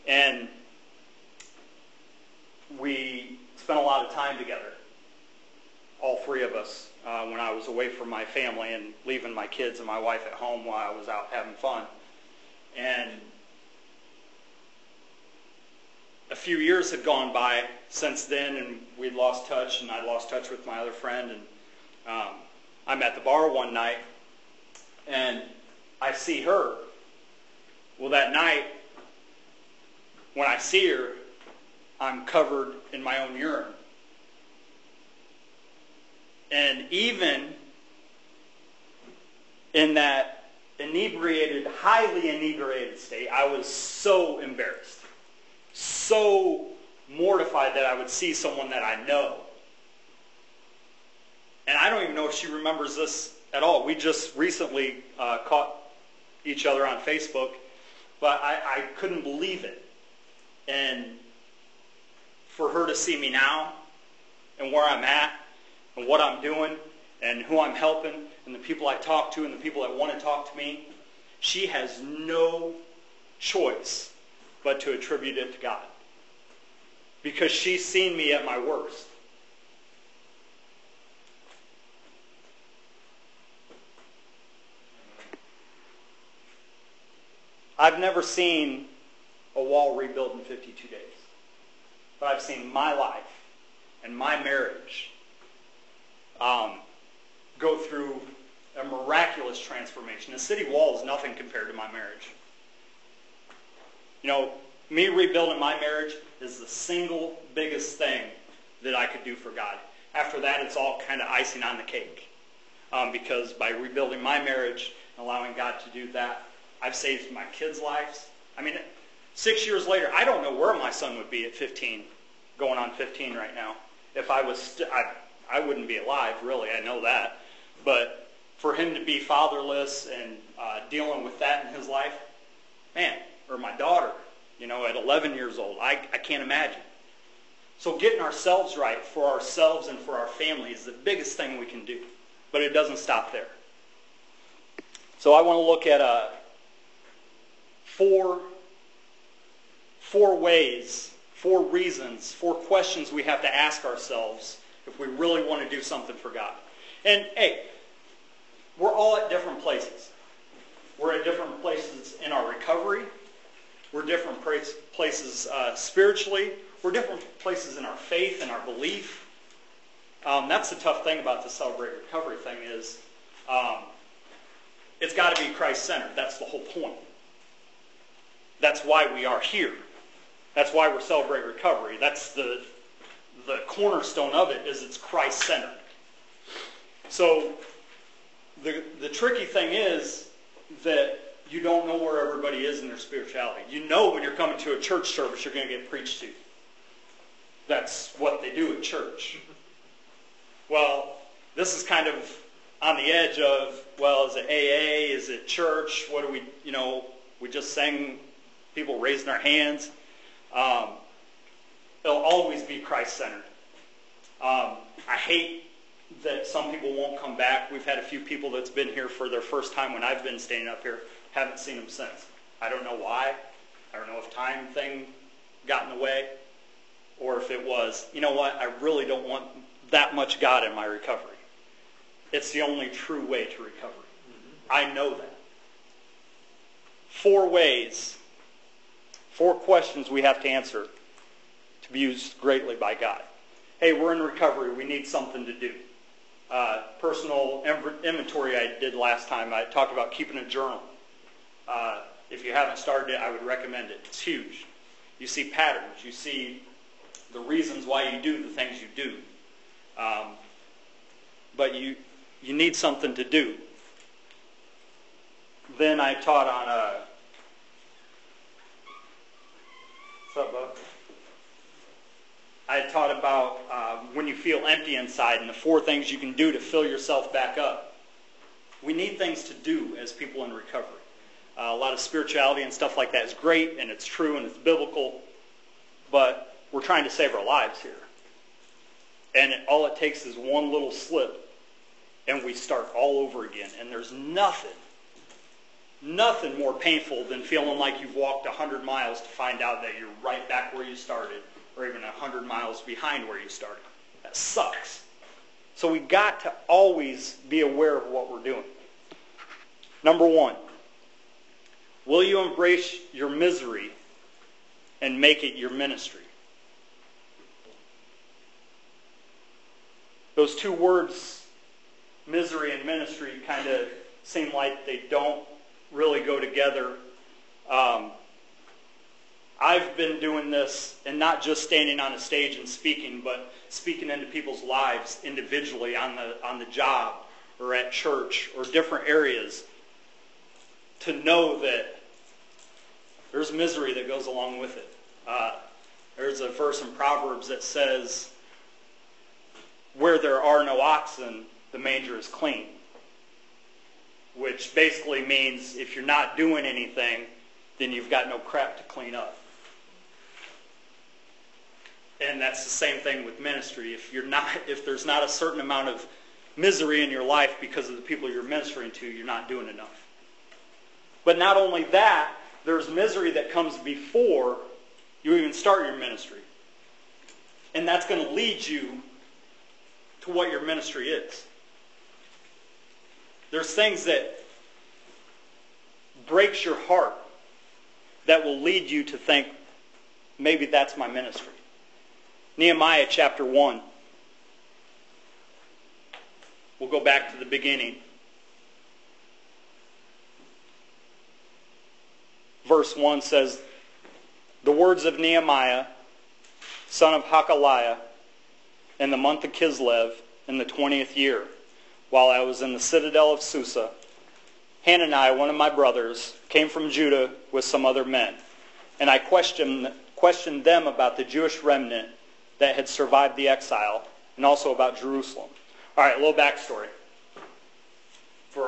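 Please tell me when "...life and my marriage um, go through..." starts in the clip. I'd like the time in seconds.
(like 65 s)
92 s.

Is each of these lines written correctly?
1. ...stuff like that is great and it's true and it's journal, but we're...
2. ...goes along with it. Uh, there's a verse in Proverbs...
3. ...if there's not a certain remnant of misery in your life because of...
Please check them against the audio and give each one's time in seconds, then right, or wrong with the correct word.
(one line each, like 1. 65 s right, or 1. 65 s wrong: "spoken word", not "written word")
1. 282 s wrong: "biblical", not "journal"
2. 344 s right
3. 364 s wrong: "amount", not "remnant".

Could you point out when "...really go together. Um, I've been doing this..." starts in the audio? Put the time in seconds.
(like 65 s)
325 s.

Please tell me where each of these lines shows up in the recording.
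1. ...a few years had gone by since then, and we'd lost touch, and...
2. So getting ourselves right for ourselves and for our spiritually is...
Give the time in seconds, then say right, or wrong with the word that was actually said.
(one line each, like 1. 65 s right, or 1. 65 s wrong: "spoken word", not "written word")
1. 16 s right
2. 137 s wrong: "family", not "spiritually".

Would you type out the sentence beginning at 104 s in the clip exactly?
You know, me rebuilding my marriage is the single biggest thing that I could do for God.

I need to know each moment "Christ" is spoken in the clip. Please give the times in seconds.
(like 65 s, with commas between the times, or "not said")
175 s, 184 s, 212 s.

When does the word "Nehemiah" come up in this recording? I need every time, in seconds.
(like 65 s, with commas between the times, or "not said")
392 s, 405 s.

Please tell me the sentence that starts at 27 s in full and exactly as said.
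Well, that night, when I see her, I'm covered in my own urine.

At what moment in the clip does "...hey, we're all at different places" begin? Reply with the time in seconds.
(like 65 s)
157 s.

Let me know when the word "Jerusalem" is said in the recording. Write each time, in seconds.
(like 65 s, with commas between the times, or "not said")
424 s.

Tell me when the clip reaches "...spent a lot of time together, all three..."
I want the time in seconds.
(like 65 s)
3 s.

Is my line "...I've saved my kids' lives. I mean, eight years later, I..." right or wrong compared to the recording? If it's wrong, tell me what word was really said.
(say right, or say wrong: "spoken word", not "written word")
wrong: "six", not "eight".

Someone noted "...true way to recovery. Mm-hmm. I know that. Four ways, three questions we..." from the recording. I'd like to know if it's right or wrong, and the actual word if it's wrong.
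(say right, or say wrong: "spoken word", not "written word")
wrong: "four", not "three".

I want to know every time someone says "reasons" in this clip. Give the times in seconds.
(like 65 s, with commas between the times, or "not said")
151 s, 257 s.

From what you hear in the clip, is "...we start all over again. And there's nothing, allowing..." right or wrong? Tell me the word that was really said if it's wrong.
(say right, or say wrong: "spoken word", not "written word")
wrong: "nothing", not "allowing".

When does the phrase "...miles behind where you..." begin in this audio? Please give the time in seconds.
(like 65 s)
302 s.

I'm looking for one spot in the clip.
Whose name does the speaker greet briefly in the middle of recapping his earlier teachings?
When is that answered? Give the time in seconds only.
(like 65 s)
270 s.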